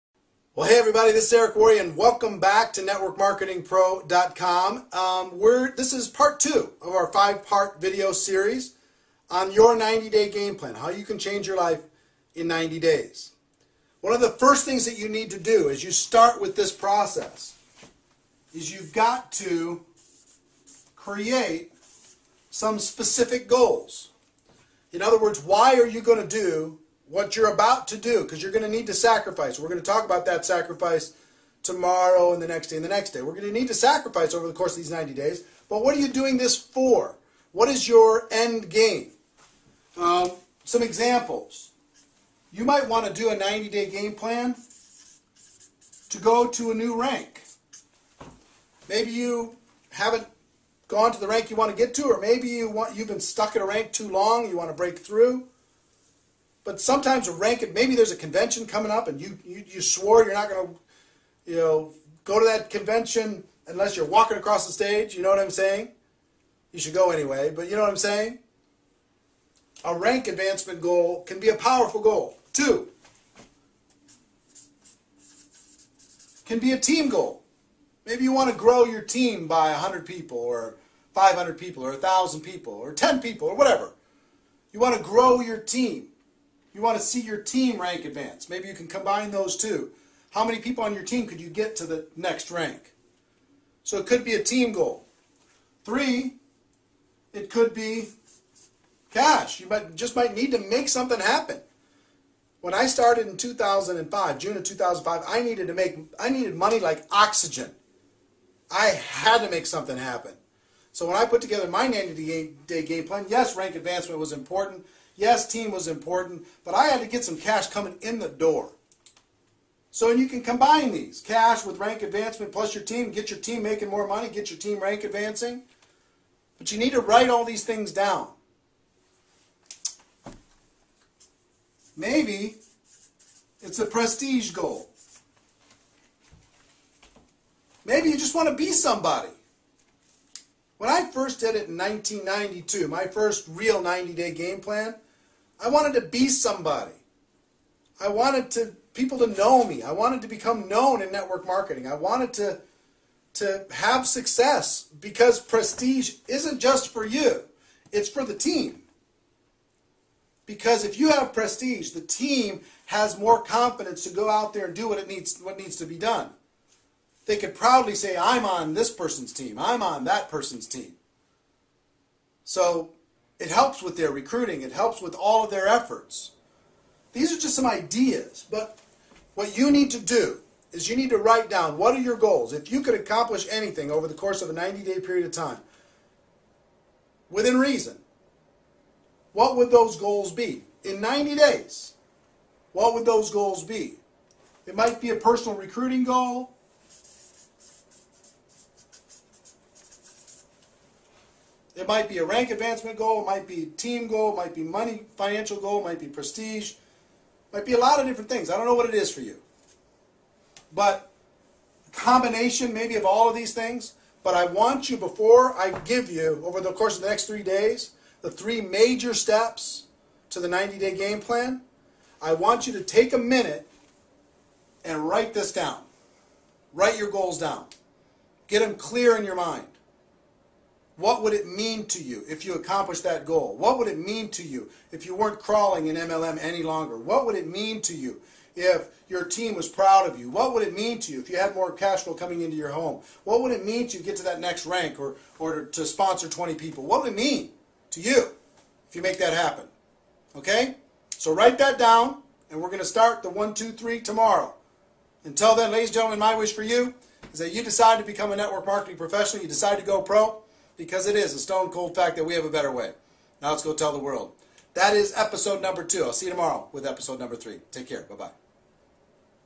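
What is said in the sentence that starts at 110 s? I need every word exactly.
So when I put together my 90-day game plan, yes, rank advancement was important.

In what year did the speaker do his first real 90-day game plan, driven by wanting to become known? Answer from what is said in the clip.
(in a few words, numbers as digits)
1992.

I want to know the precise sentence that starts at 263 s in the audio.
Now let's go tell the world.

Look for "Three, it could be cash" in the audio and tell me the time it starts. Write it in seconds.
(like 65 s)
95 s.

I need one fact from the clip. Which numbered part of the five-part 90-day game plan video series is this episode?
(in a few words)
Part 2.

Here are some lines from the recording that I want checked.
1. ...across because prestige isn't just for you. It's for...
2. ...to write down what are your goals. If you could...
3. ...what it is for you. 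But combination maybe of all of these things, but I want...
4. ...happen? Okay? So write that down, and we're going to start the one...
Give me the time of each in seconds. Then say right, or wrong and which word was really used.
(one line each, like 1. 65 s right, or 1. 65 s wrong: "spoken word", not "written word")
1. 154 s wrong: "success", not "across"
2. 181 s right
3. 208 s right
4. 249 s right.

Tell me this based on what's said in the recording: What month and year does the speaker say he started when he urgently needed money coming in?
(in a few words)
June 2005.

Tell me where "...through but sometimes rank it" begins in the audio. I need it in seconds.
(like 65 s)
54 s.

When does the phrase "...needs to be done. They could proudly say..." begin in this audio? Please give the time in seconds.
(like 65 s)
165 s.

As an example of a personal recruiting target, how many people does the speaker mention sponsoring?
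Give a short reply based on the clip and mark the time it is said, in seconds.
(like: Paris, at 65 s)
20, at 246 s.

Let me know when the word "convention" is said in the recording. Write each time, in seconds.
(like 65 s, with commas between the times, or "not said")
58 s, 62 s.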